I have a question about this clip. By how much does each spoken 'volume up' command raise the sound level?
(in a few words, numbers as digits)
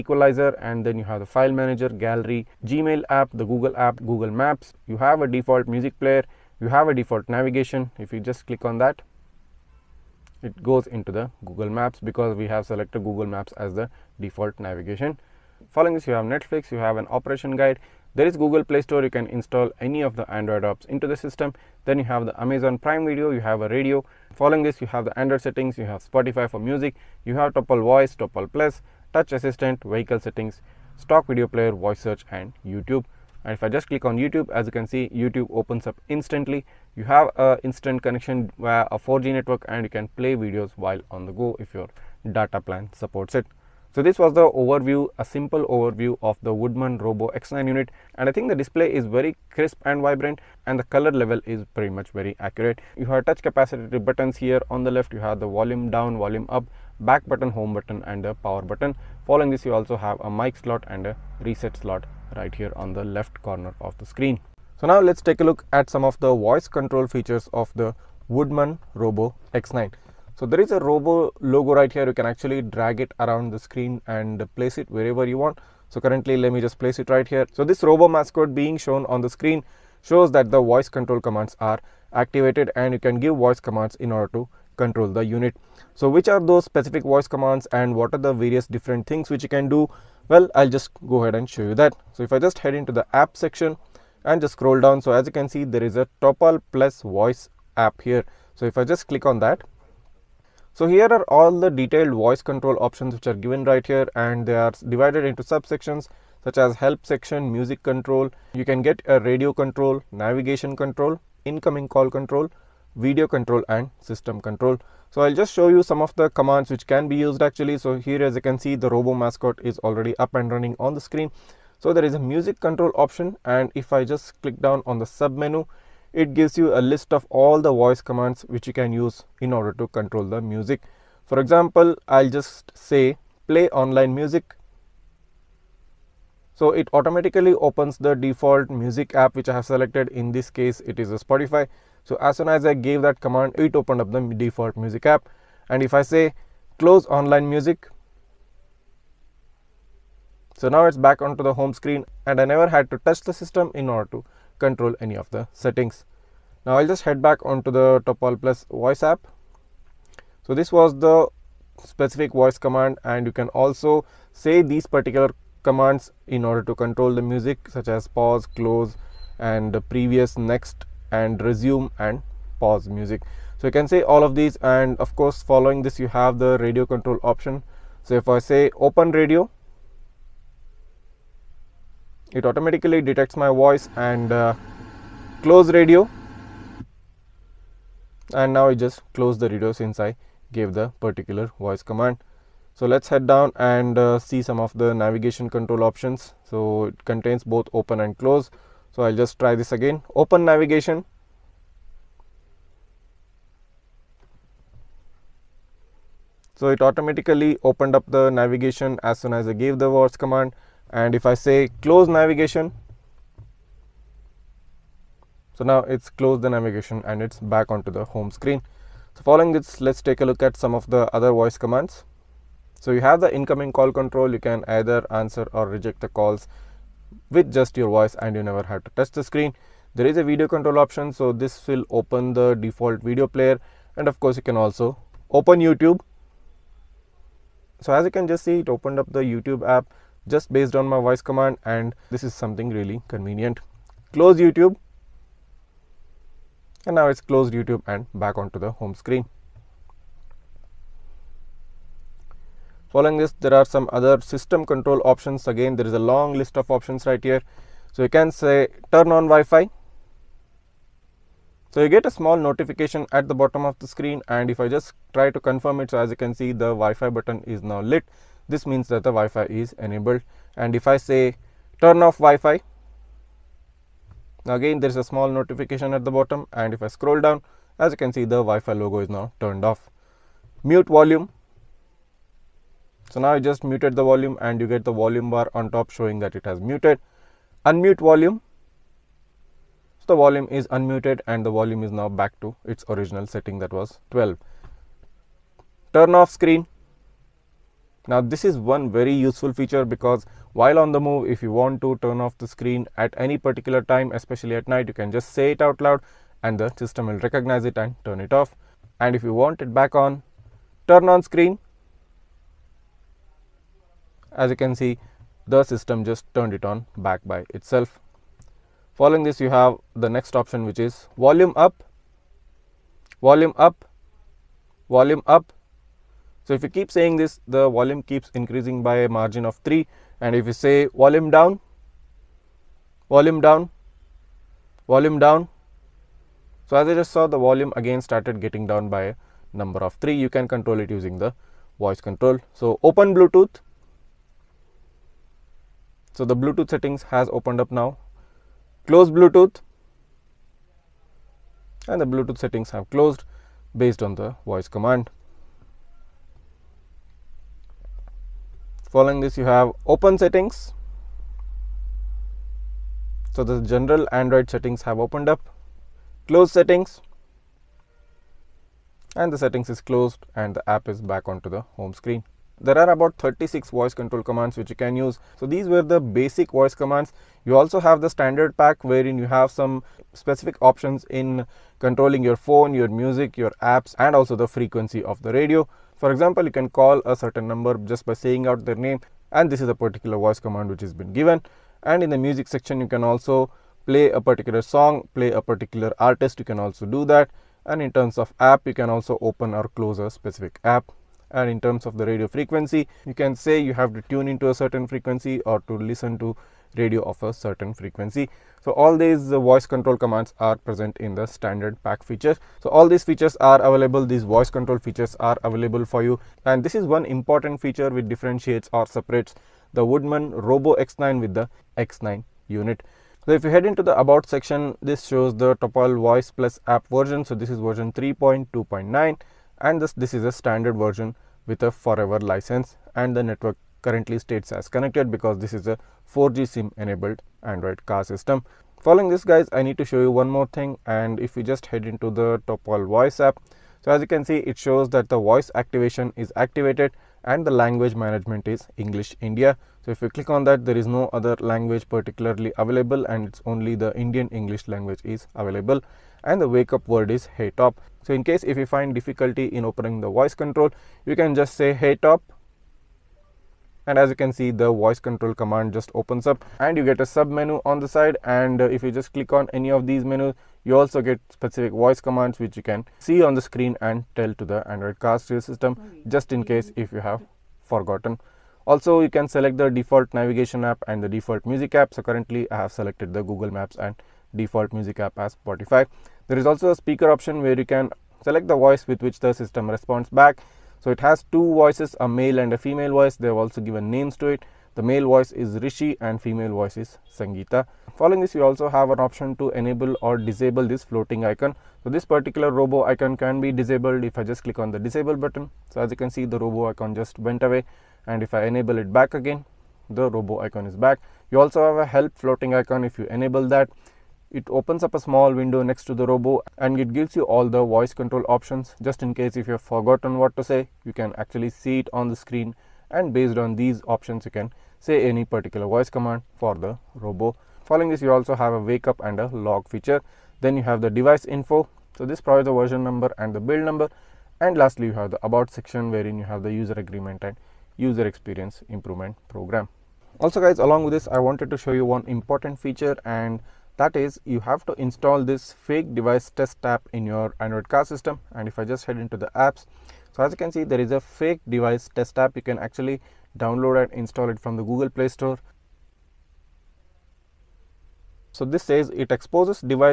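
3.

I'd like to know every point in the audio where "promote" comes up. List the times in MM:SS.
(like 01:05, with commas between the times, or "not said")
not said.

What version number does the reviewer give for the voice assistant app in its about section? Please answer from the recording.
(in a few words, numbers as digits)
3.2.9.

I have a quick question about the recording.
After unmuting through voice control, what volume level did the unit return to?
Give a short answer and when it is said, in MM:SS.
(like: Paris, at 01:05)
12, at 04:53.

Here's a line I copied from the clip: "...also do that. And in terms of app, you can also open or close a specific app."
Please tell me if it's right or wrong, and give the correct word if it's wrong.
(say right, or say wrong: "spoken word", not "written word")
right.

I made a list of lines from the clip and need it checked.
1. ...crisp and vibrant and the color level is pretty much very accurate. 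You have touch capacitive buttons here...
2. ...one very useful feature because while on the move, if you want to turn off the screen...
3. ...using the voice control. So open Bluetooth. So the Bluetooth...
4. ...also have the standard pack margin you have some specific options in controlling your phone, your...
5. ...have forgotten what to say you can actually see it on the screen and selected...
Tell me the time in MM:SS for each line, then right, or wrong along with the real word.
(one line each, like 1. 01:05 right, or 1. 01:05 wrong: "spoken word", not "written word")
1. 00:49 right
2. 04:58 right
3. 05:40 right
4. 06:17 wrong: "wherein", not "margin"
5. 08:39 wrong: "based", not "selected".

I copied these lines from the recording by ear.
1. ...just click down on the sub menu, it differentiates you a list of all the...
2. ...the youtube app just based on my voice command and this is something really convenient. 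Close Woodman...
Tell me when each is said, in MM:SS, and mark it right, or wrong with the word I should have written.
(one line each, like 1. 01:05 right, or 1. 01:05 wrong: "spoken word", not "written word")
1. 02:04 wrong: "gives", not "differentiates"
2. 03:59 wrong: "YouTube", not "Woodman".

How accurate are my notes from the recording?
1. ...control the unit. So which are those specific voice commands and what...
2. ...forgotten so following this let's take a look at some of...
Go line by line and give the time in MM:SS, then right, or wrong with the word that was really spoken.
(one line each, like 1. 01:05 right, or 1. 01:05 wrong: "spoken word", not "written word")
1. 01:24 right
2. 03:38 wrong: "screen", not "forgotten".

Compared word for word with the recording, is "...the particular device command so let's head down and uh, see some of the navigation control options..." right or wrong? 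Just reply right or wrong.
wrong.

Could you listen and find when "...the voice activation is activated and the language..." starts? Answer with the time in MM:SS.
07:25.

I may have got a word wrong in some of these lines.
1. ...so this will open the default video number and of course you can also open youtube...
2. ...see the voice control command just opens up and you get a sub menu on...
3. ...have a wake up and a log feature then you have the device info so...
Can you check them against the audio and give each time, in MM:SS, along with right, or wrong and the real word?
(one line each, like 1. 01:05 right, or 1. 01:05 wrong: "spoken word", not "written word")
1. 03:51 wrong: "player", not "number"
2. 07:44 right
3. 08:48 right.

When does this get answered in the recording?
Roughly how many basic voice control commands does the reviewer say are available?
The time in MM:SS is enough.
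06:12.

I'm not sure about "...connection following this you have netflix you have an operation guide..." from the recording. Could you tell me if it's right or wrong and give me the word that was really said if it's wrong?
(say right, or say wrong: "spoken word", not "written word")
wrong: "navigation", not "connection".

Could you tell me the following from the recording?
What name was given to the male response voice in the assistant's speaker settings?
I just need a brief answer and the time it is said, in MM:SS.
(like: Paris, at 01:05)
Rishi, at 08:14.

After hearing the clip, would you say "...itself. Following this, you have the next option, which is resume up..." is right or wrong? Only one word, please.
wrong.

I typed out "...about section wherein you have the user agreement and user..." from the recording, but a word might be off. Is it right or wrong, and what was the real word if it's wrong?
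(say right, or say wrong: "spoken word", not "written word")
right.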